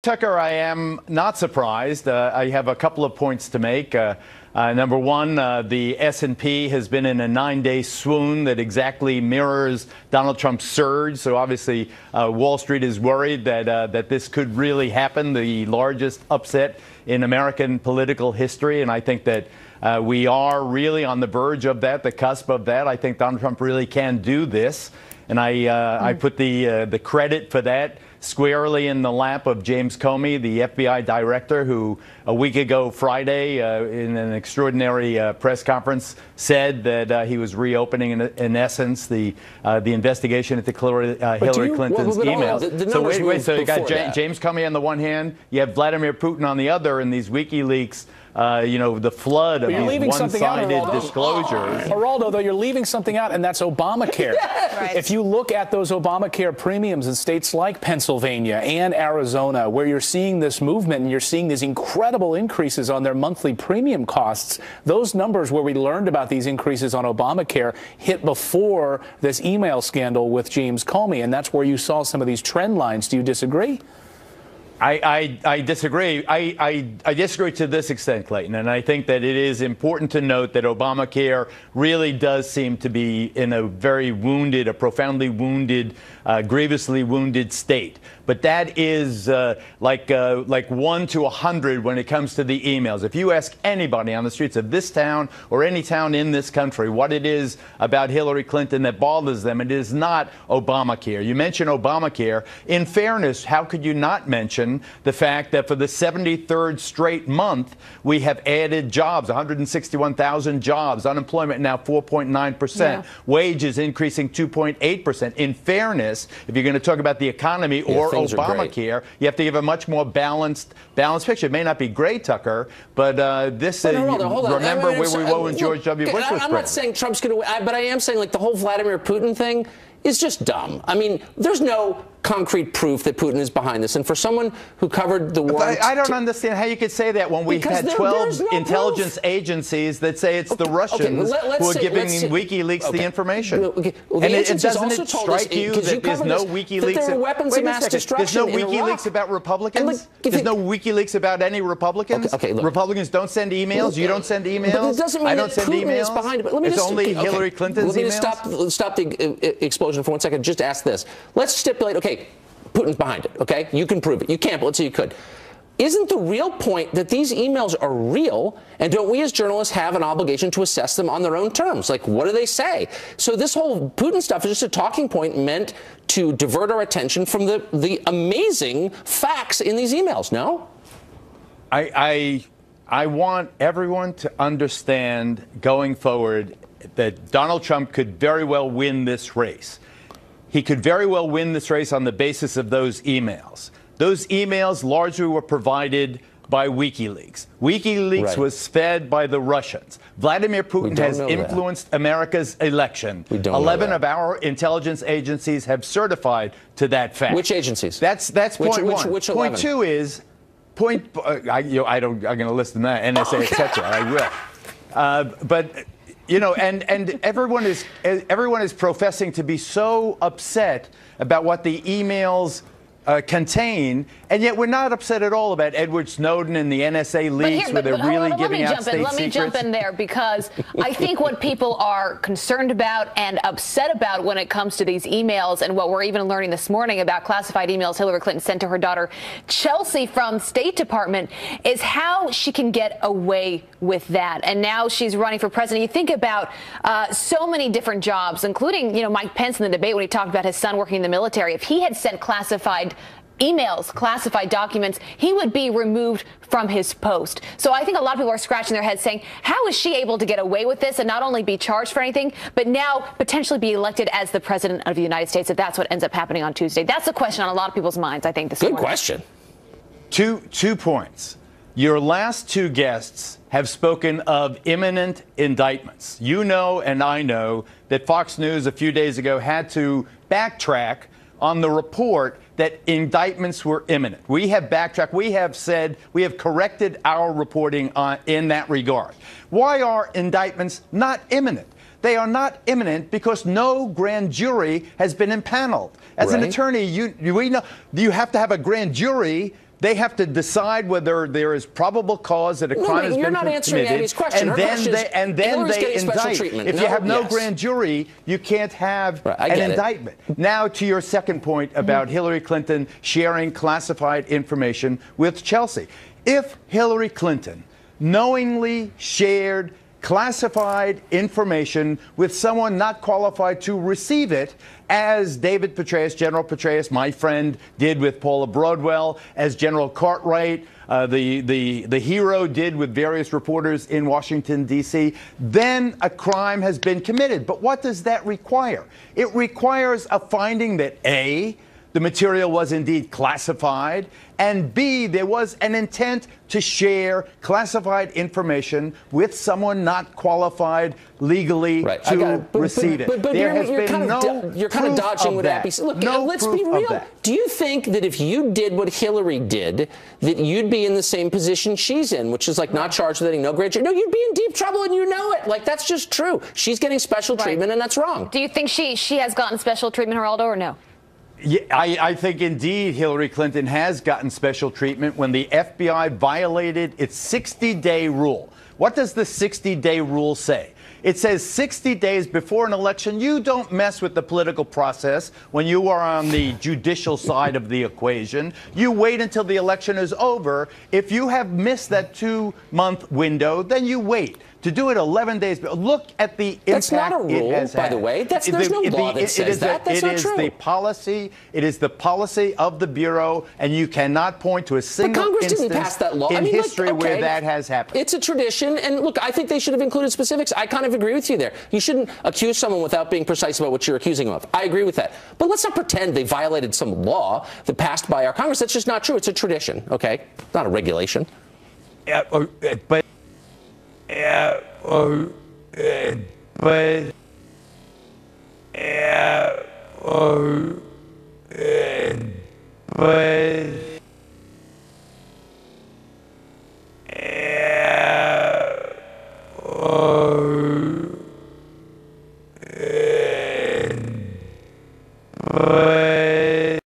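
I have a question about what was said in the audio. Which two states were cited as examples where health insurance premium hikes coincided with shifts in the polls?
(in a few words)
Pennsylvania and Arizona.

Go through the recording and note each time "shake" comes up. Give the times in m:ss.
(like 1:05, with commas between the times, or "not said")
not said.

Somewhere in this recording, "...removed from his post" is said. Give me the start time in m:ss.
4:15.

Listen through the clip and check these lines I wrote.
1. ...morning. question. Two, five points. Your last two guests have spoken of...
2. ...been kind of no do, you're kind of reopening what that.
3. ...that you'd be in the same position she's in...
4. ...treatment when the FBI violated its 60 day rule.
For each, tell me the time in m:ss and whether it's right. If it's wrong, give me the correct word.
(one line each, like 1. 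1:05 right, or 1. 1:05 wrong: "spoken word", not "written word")
1. 4:28 wrong: "two", not "five"
2. 5:53 wrong: "dodging", not "reopening"
3. 6:00 right
4. 6:14 right.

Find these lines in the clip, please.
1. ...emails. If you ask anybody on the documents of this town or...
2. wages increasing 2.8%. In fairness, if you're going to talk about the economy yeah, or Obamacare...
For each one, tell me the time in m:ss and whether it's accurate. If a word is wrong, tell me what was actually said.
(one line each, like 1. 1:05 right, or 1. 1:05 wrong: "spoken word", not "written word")
1. 1:32 wrong: "streets", not "documents"
2. 1:53 right.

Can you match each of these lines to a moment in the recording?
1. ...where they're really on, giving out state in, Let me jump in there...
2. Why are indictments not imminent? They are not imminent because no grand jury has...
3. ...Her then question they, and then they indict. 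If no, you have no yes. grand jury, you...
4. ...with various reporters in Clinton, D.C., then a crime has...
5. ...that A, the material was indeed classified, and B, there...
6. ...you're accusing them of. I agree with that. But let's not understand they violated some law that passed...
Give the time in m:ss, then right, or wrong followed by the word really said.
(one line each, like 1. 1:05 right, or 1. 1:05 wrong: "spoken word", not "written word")
1. 3:47 right
2. 4:49 right
3. 5:04 right
4. 5:32 wrong: "Washington", not "Clinton"
5. 5:40 right
6. 6:53 wrong: "pretend", not "understand".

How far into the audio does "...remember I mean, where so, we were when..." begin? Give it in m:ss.
2:04.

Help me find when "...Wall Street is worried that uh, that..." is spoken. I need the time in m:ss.
0:12.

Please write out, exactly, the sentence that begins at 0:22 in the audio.
I think Donald Trump really can do this, and I mm.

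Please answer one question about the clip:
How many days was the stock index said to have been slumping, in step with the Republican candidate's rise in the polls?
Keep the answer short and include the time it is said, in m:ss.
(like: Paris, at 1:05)
9, at 0:07.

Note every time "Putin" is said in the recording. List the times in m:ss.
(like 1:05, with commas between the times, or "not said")
0:46, 2:08, 2:13, 2:35, 2:42, 2:53, 3:20.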